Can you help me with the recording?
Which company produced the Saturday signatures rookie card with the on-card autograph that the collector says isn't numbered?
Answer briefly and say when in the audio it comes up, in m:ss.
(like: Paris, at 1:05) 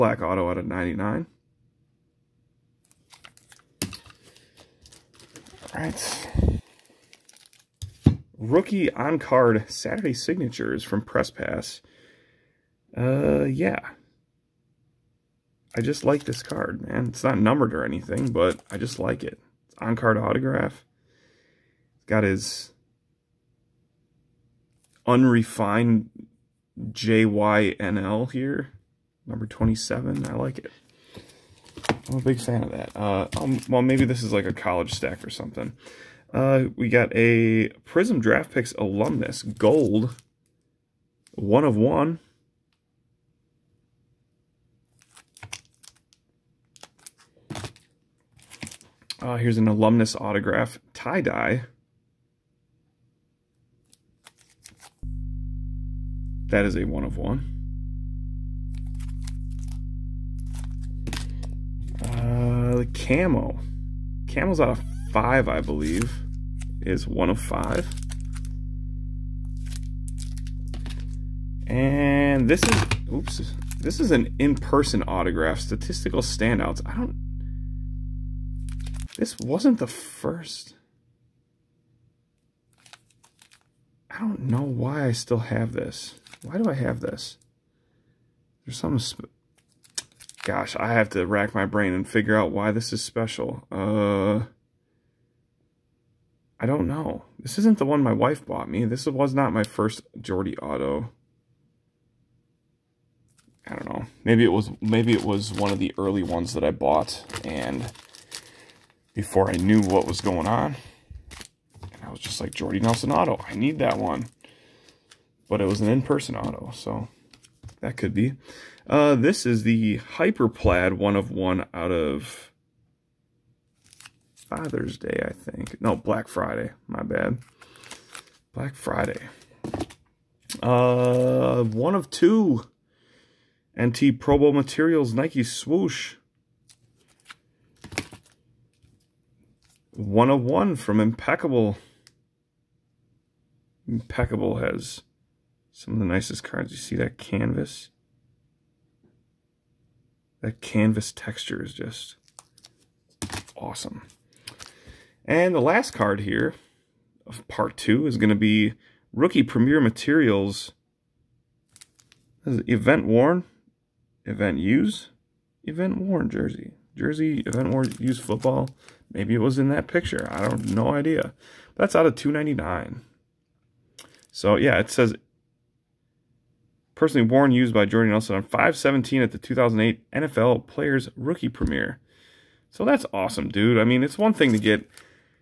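Press Pass, at 0:11.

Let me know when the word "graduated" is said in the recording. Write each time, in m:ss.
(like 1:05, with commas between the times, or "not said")
not said.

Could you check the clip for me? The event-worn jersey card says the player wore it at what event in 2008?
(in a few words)
NFL Players Rookie Premiere.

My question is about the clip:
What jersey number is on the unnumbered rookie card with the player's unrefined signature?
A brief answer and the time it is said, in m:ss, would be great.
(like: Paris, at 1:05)
27, at 0:29.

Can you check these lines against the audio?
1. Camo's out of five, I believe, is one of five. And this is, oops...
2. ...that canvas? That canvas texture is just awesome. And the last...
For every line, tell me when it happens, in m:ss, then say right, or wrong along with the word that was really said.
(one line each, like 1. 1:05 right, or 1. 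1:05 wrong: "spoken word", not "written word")
1. 1:04 right
2. 2:26 right.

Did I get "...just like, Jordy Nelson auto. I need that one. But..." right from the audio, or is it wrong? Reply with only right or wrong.
right.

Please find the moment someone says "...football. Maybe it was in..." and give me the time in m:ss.
2:48.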